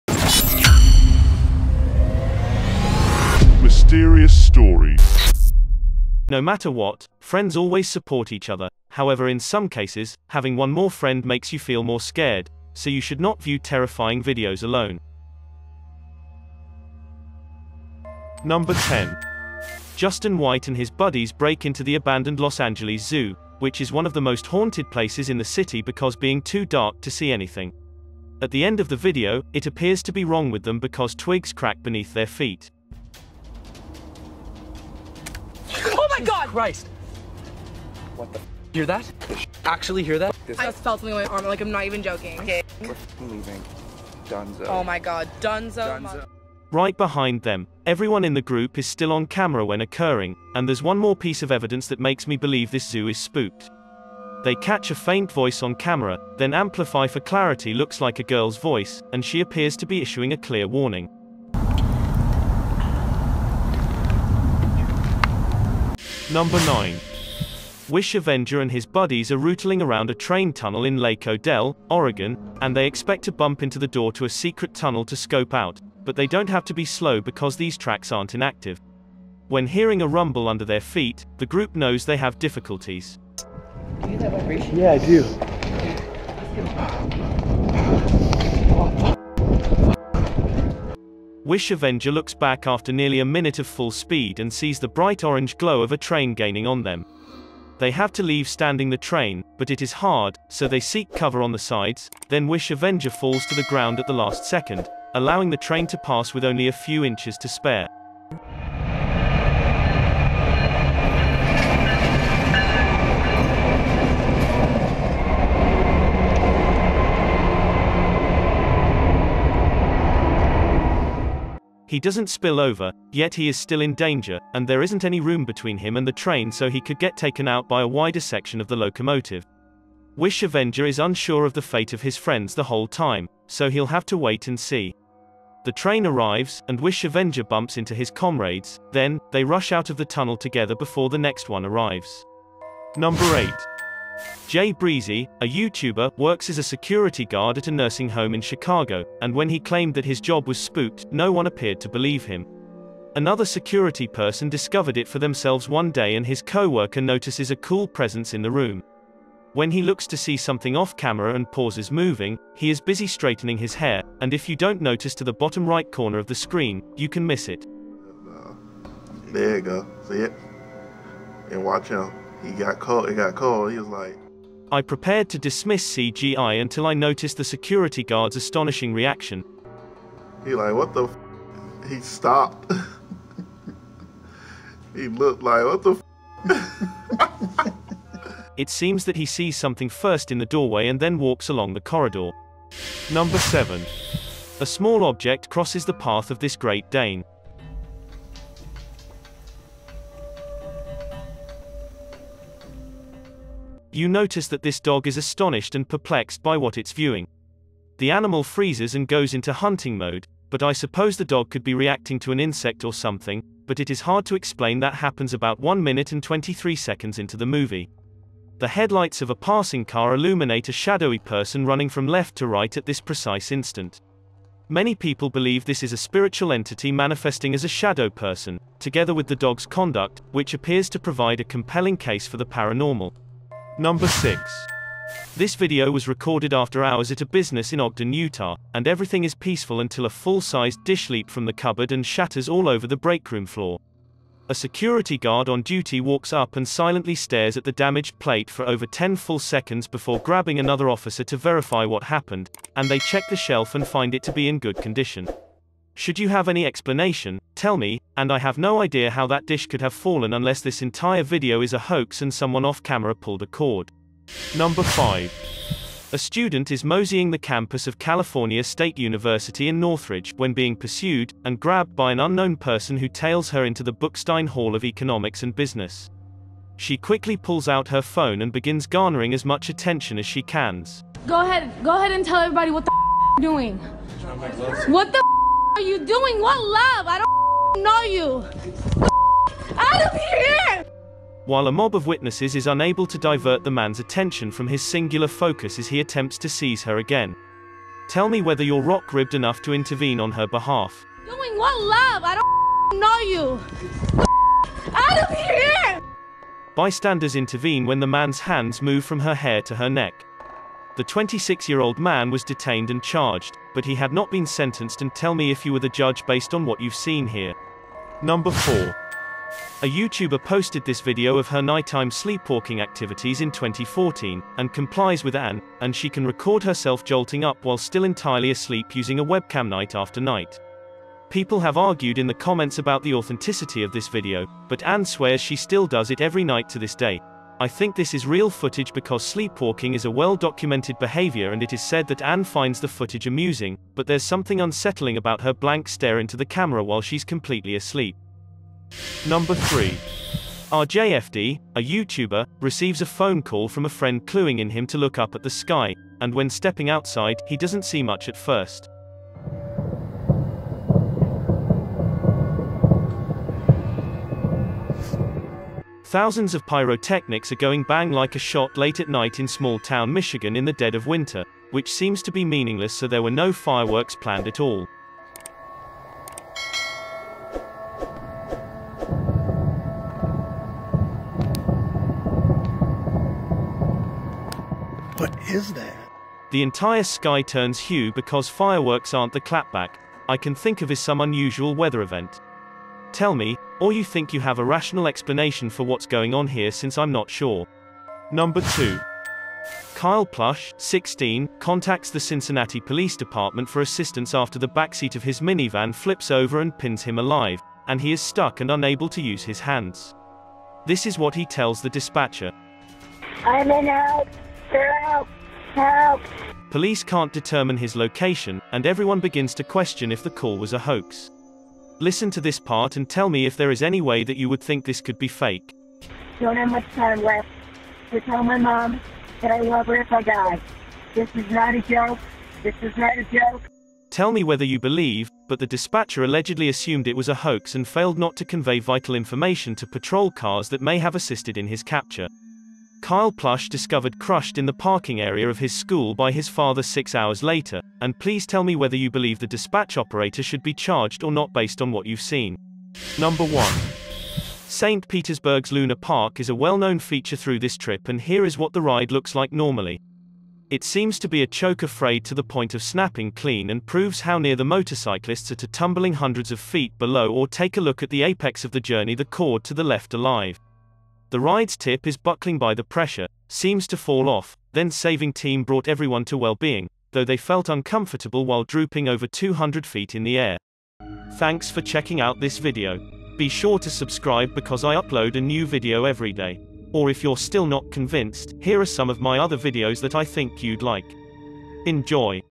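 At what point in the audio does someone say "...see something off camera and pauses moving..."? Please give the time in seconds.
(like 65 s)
160 s.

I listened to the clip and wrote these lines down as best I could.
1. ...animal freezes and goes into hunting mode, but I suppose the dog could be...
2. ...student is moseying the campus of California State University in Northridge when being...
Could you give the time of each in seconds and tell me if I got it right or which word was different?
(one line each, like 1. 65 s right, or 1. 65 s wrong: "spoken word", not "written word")
1. 208 s right
2. 266 s right.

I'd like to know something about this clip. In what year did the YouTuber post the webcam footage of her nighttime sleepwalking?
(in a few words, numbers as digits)
2014.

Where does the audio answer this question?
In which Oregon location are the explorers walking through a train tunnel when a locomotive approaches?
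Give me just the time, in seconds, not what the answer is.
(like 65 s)
70 s.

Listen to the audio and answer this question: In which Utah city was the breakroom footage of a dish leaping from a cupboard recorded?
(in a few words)
Ogden.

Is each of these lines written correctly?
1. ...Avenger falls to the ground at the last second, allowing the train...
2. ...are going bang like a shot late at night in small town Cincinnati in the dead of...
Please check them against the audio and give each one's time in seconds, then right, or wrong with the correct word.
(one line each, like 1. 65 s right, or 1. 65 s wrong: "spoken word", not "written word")
1. 102 s right
2. 367 s wrong: "Michigan", not "Cincinnati".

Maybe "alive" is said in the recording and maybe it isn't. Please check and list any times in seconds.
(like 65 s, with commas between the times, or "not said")
407 s, 470 s.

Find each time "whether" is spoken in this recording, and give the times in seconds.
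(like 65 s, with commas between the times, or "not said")
298 s, 434 s, 448 s.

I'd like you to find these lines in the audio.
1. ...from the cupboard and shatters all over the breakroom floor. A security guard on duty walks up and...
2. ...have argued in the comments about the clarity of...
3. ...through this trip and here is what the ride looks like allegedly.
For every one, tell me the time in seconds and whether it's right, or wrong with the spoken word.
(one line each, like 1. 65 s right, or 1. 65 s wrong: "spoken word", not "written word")
1. 241 s right
2. 331 s wrong: "authenticity", not "clarity"
3. 457 s wrong: "normally", not "allegedly".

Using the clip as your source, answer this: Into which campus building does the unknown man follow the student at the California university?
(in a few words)
Bookstein Hall.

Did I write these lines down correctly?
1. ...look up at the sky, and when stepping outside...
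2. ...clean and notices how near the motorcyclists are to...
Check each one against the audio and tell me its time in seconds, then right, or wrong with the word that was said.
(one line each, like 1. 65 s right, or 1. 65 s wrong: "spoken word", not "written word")
1. 354 s right
2. 463 s wrong: "proves", not "notices".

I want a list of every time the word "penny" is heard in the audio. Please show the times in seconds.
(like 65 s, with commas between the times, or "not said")
not said.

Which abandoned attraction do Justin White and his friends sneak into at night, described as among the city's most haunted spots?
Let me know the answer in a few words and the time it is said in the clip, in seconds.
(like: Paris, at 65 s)
Los Angeles Zoo, at 22 s.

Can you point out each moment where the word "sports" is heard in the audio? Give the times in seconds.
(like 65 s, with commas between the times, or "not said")
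not said.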